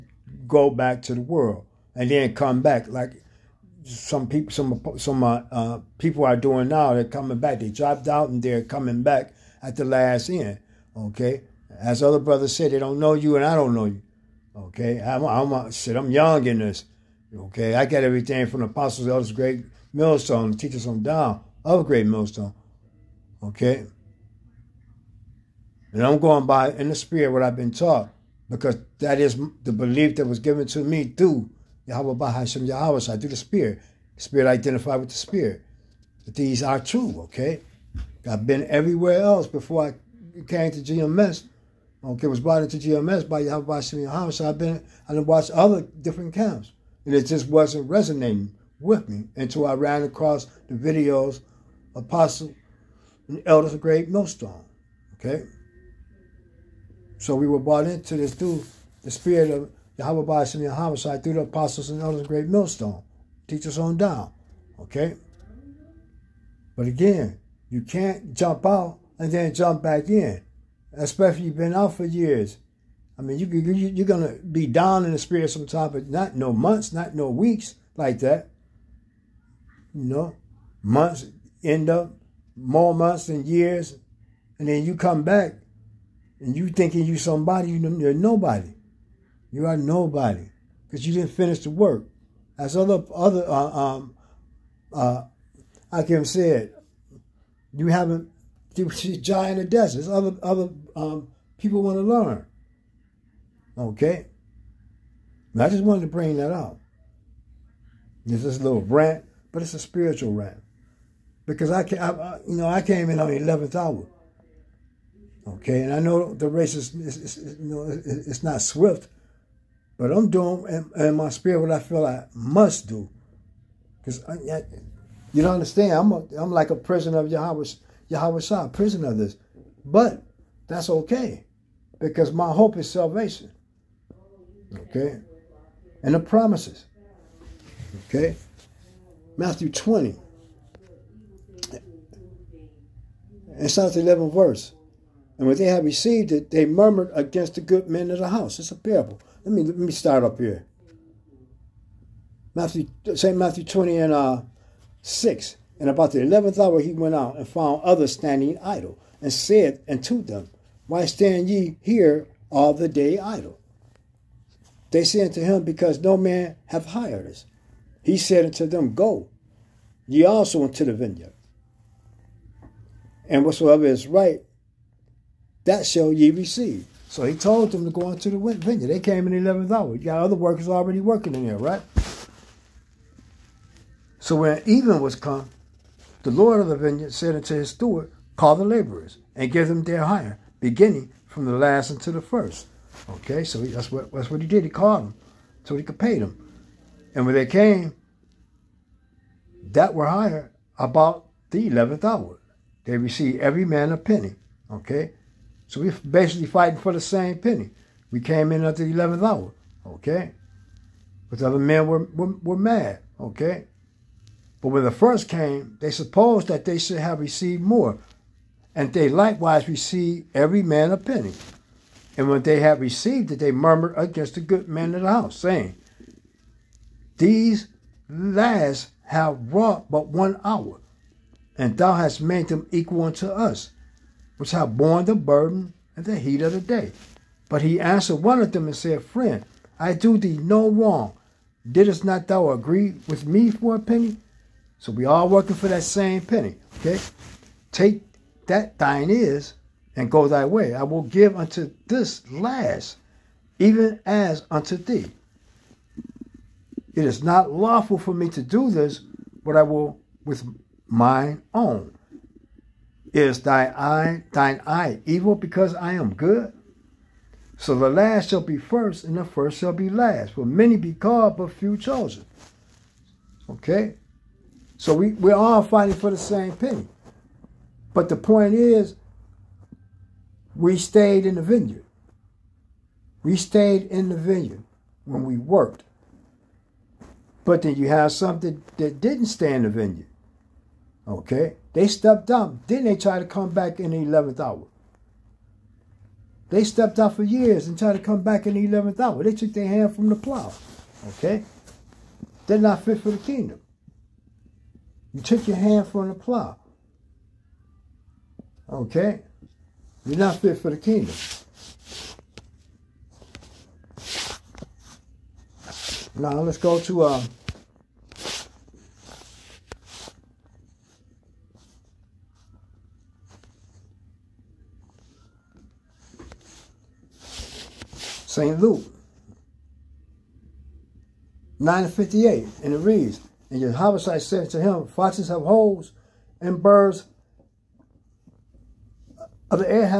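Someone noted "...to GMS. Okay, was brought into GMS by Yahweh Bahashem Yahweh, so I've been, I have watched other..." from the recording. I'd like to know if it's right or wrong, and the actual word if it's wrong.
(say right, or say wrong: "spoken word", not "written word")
right.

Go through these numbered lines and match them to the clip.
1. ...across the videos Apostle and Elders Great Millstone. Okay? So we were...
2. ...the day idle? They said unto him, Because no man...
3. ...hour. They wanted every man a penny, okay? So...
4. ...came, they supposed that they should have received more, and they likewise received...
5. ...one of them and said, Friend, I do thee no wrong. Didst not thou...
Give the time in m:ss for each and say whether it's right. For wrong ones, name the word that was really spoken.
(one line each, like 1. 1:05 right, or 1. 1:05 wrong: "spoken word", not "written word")
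1. 0:50 right
2. 2:42 right
3. 3:22 wrong: "received", not "wanted"
4. 3:35 right
5. 3:58 right.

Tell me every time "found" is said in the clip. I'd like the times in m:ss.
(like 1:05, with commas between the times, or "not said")
2:37.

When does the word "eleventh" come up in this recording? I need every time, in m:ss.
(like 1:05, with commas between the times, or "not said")
1:53, 2:36.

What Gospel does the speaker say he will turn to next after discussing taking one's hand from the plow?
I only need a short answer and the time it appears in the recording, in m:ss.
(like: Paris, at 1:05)
Luke, at 5:28.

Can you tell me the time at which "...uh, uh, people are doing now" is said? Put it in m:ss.
0:05.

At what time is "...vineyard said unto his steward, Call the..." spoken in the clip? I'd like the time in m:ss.
3:06.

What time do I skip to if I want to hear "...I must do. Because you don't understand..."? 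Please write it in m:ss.
2:02.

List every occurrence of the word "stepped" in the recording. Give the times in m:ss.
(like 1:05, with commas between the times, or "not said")
4:51, 4:56.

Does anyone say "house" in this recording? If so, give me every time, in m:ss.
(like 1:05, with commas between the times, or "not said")
2:28, 3:45.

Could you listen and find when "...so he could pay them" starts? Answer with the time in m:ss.
3:15.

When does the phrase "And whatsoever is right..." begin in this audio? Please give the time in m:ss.
2:53.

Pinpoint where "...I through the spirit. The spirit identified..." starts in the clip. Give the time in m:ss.
0:33.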